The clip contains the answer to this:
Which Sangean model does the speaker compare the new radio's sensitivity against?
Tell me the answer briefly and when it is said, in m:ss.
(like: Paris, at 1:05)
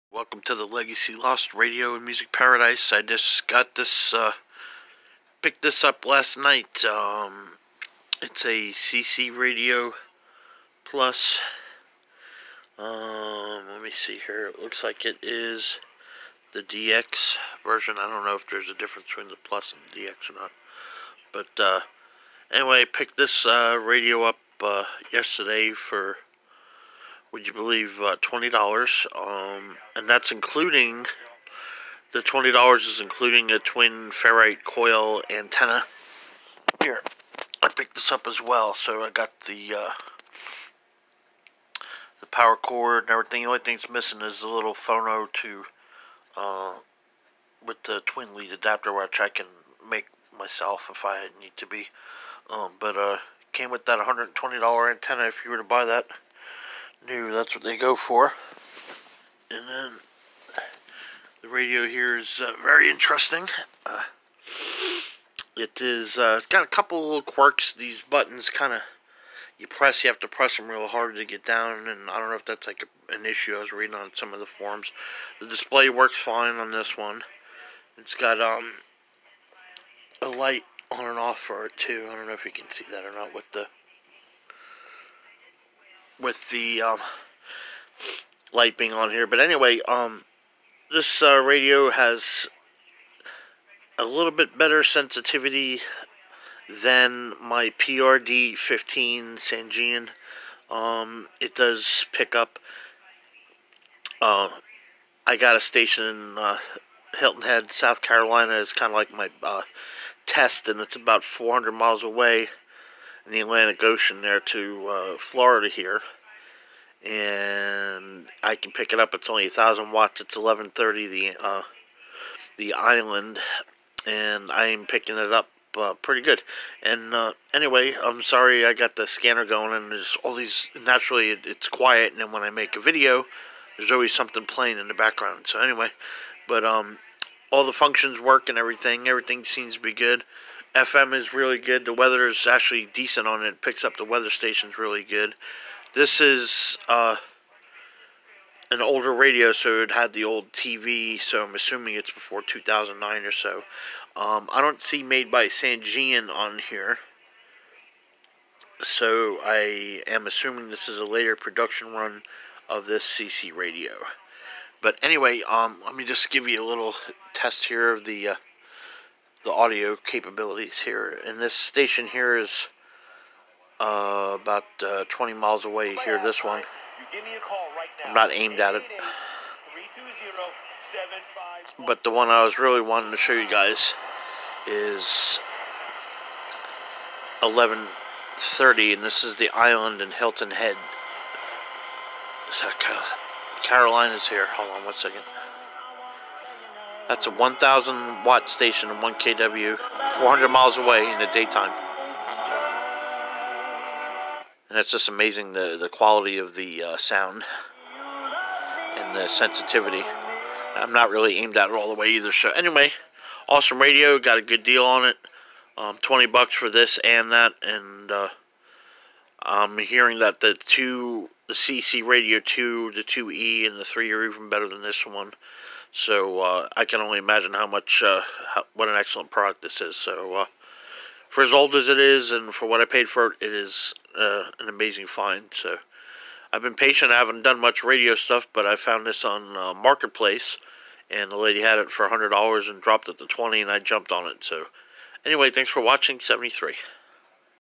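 PRD 15, at 1:37.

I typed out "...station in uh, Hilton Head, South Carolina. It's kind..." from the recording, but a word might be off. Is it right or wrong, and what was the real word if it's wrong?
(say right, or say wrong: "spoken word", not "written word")
right.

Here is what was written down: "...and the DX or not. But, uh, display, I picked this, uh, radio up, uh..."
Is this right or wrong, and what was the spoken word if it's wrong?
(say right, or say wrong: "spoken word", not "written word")
wrong: "anyway", not "display".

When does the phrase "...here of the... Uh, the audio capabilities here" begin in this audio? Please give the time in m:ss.
2:47.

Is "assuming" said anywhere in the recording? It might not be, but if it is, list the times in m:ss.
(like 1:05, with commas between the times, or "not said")
2:31, 2:40.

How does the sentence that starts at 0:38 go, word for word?
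So I got the, uh, the power cord and everything.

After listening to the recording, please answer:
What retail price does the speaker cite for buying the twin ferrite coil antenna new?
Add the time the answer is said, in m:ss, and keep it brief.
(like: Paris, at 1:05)
$120, at 0:53.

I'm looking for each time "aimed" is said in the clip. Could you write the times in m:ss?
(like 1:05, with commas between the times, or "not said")
2:58, 3:31.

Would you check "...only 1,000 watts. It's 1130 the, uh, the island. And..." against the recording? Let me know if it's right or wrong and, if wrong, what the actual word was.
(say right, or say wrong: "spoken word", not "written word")
right.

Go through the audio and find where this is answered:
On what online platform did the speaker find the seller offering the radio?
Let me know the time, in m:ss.
3:59.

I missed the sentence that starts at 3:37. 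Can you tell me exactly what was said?
And uh, I'm hearing that the two the CC Radio 2, the 2E, and the 3 are even better than this one.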